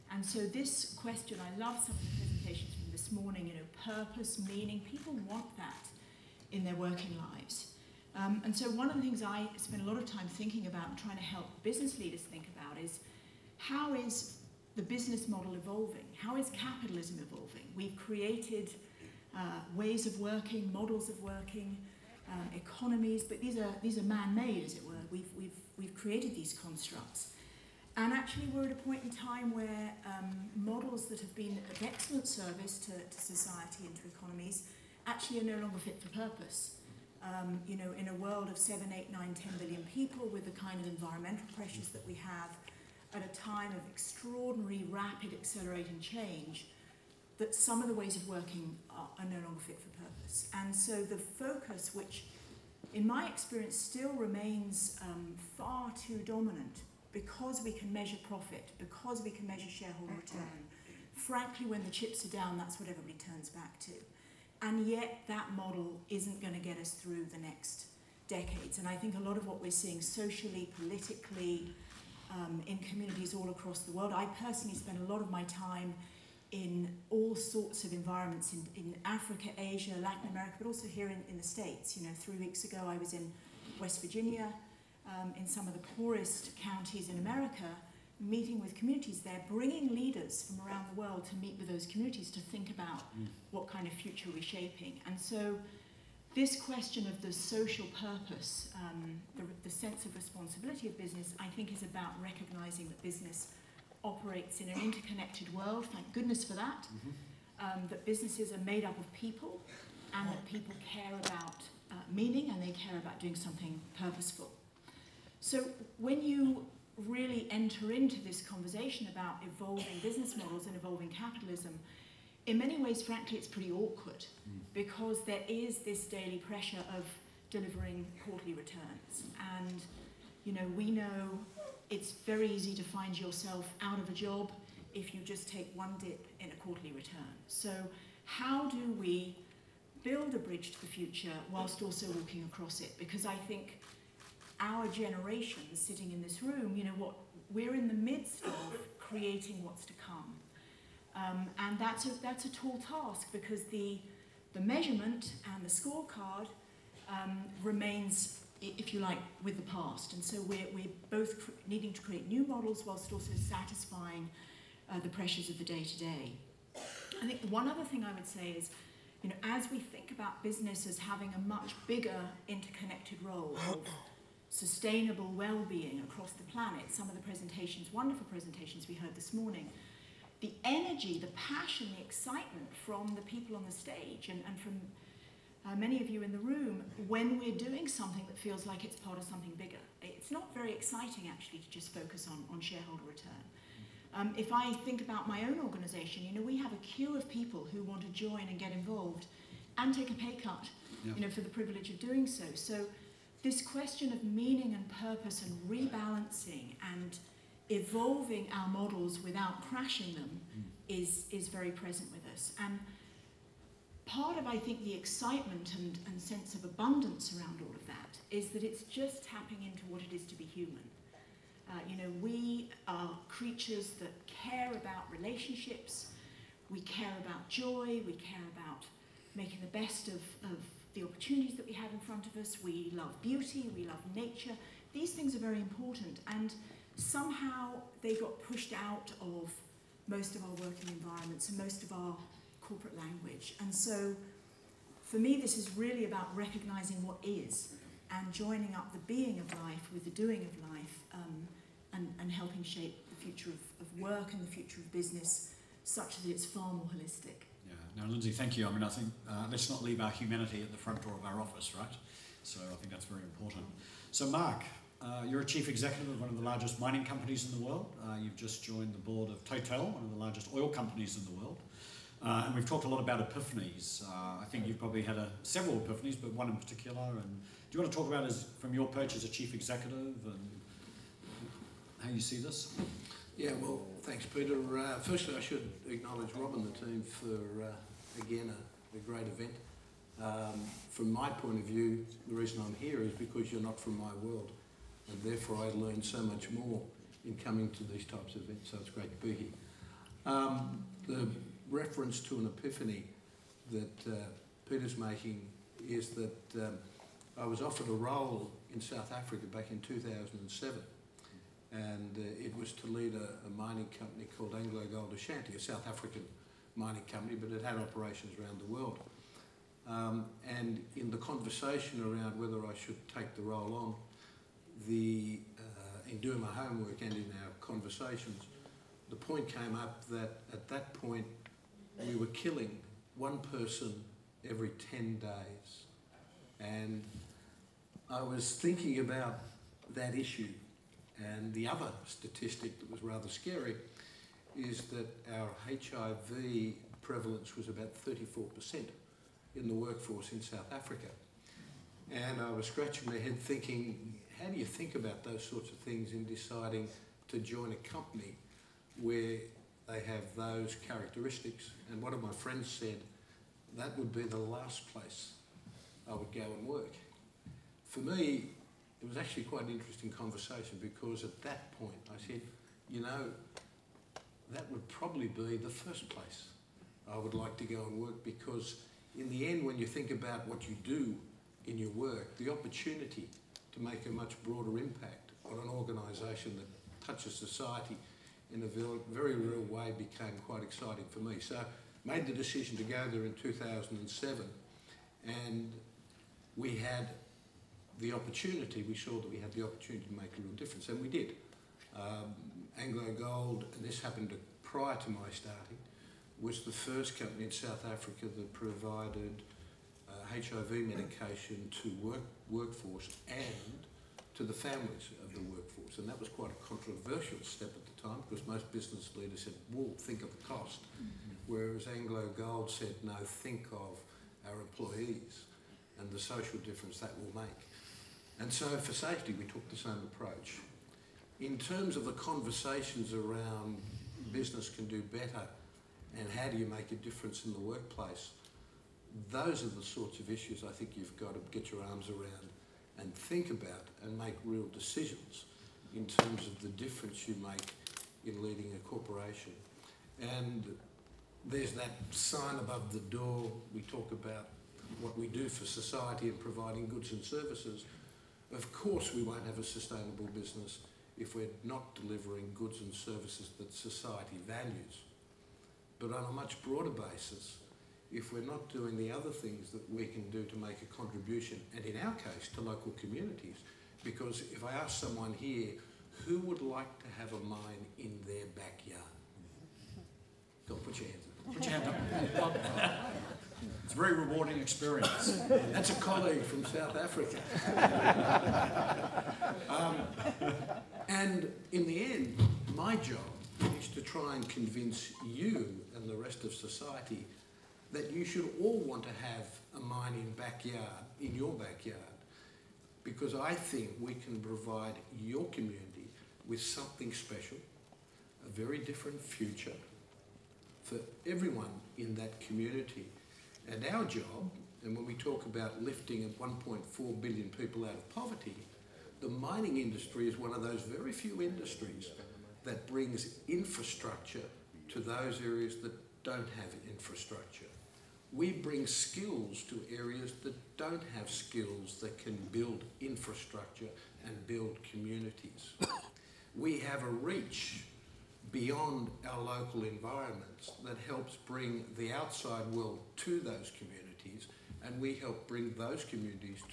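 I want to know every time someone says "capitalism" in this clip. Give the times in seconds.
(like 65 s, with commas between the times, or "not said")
16 s, 121 s.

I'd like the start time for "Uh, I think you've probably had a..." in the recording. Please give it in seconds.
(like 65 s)
274 s.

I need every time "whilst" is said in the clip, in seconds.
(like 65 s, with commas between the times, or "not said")
141 s, 162 s.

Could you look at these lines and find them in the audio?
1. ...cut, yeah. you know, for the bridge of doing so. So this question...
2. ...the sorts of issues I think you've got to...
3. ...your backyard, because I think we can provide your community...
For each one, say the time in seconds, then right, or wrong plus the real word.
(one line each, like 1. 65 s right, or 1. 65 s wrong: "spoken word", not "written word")
1. 200 s wrong: "privilege", not "bridge"
2. 439 s right
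3. 501 s right.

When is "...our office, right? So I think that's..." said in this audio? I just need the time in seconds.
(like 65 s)
261 s.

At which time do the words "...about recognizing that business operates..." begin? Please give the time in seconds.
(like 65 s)
101 s.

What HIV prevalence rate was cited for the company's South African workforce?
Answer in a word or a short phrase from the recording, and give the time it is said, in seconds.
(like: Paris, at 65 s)
34%, at 348 s.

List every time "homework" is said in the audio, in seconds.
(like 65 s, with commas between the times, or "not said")
326 s.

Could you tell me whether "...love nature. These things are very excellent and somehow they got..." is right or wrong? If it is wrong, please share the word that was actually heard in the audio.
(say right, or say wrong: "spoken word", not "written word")
wrong: "important", not "excellent".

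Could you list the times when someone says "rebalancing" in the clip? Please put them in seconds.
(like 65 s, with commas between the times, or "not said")
205 s.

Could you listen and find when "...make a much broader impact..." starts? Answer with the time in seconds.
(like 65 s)
383 s.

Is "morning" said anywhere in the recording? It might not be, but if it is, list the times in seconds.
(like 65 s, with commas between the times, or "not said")
3 s, 179 s.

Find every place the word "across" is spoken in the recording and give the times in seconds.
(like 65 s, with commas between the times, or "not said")
73 s, 142 s, 176 s.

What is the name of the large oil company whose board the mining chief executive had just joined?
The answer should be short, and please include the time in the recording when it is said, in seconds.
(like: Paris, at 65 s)
Total, at 269 s.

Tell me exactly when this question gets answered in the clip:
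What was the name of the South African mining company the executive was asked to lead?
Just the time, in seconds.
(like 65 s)
314 s.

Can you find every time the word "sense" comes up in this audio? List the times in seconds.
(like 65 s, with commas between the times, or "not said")
99 s, 216 s.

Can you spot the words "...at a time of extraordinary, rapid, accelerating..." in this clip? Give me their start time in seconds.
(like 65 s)
43 s.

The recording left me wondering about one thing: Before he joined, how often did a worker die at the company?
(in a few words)
Every 10 days.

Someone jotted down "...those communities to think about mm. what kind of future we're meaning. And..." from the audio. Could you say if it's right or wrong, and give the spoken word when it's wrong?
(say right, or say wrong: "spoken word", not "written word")
wrong: "shaping", not "meaning".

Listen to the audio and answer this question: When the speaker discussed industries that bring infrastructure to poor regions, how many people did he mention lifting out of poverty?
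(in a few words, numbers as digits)
1.4 billion.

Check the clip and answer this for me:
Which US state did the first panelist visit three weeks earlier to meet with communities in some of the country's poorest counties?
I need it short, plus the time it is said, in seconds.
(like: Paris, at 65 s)
West Virginia, at 83 s.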